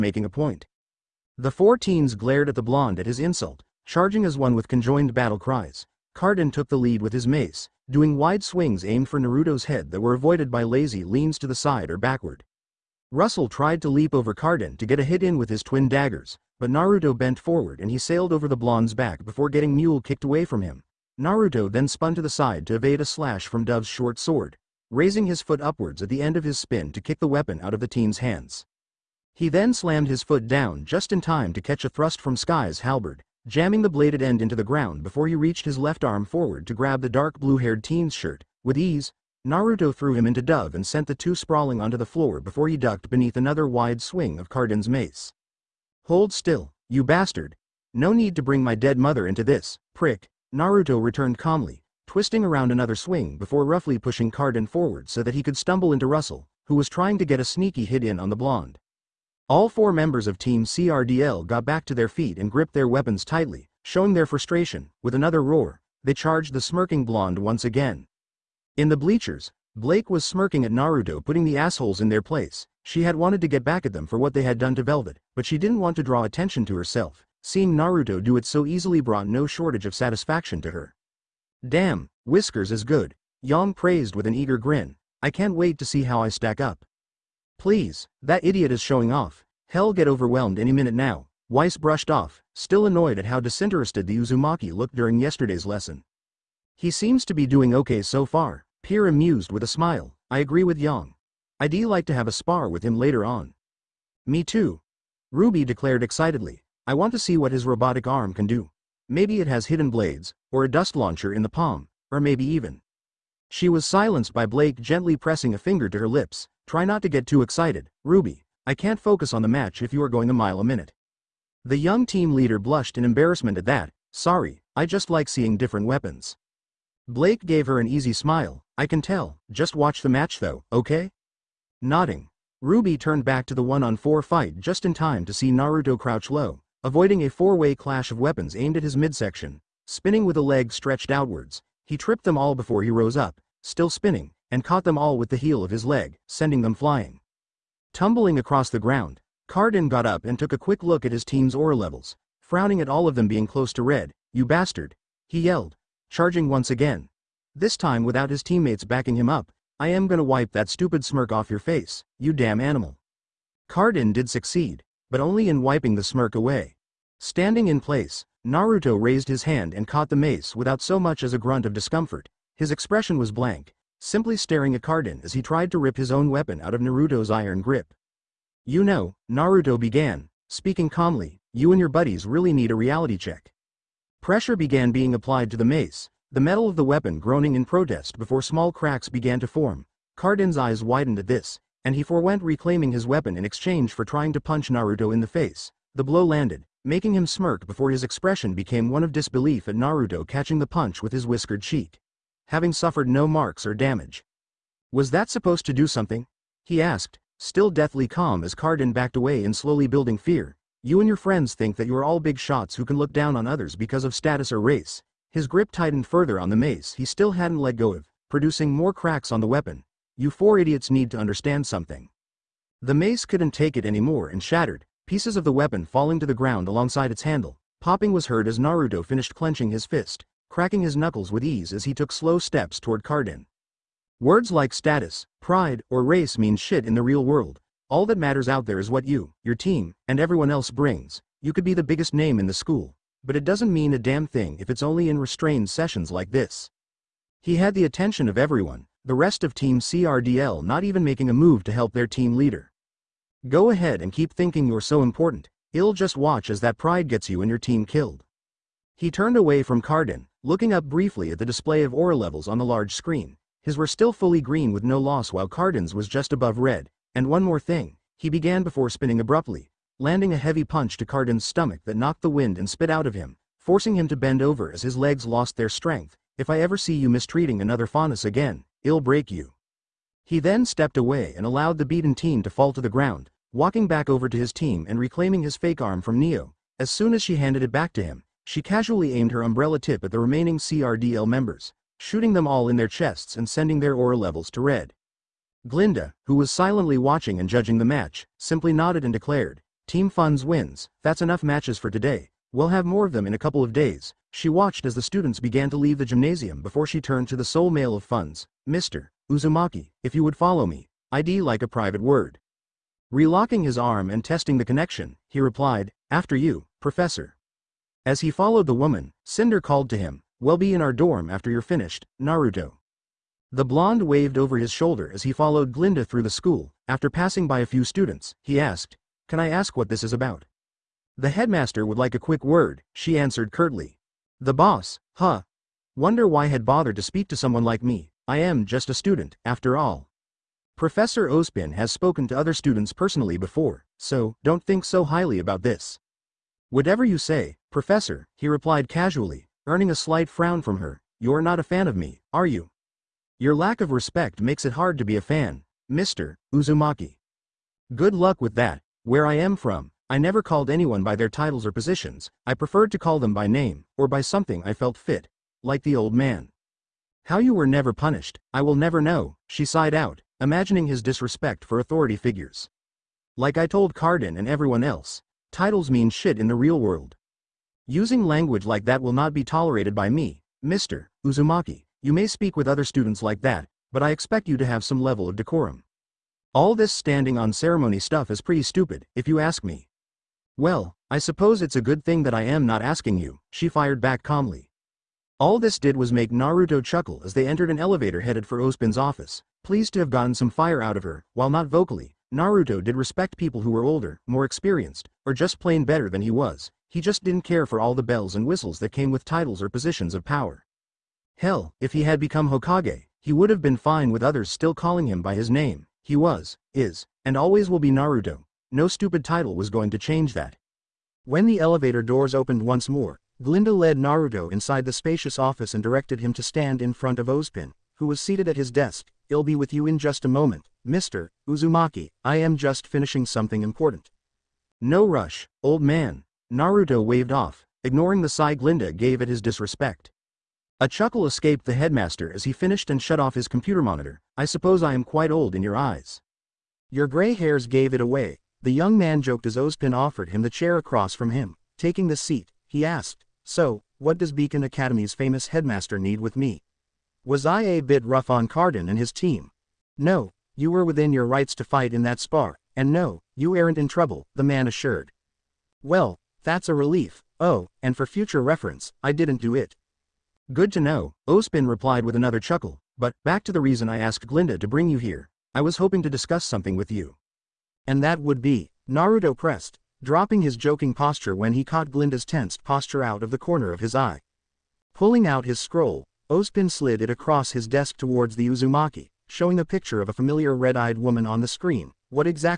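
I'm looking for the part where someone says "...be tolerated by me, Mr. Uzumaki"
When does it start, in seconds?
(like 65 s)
379 s.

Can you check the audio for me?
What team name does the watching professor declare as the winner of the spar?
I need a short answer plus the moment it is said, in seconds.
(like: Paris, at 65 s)
Team Funds, at 299 s.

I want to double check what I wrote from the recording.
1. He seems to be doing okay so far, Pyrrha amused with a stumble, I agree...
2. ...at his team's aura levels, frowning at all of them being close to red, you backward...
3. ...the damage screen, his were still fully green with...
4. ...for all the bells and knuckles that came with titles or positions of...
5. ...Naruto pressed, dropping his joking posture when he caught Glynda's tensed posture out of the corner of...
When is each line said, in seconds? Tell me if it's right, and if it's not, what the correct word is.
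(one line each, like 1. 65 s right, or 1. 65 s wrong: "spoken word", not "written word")
1. 96 s wrong: "smile", not "stumble"
2. 151 s wrong: "bastard", not "backward"
3. 262 s wrong: "large", not "damage"
4. 407 s wrong: "whistles", not "knuckles"
5. 478 s right.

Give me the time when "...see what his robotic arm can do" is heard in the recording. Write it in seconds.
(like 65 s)
107 s.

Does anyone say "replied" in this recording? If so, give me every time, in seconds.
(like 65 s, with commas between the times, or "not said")
315 s, 348 s, 471 s.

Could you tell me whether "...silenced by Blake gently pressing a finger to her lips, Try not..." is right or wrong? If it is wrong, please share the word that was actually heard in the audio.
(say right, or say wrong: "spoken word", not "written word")
right.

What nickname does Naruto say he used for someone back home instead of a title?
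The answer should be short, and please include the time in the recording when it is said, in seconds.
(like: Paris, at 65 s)
the old man, at 365 s.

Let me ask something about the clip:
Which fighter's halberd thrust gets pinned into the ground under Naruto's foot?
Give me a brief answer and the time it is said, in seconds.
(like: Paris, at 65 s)
Sky, at 32 s.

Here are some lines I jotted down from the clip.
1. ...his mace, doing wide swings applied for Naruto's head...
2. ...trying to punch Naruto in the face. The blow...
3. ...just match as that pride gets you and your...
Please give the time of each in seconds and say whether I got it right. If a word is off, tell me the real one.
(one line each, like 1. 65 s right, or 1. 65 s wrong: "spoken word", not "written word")
1. 7 s wrong: "aimed", not "applied"
2. 194 s right
3. 255 s wrong: "watch", not "match".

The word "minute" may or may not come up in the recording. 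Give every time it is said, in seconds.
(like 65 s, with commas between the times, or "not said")
90 s, 120 s.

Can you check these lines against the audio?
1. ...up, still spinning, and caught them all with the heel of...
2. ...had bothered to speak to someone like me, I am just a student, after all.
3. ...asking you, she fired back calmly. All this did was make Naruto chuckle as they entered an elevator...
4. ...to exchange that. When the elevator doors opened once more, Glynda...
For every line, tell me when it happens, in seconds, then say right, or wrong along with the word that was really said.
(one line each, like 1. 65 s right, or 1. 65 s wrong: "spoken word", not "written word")
1. 143 s right
2. 336 s right
3. 392 s right
4. 419 s wrong: "change", not "exchange".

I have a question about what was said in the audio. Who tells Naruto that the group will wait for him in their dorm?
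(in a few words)
Cinder.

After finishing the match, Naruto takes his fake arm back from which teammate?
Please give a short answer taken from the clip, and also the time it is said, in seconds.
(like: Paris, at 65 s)
Neo, at 286 s.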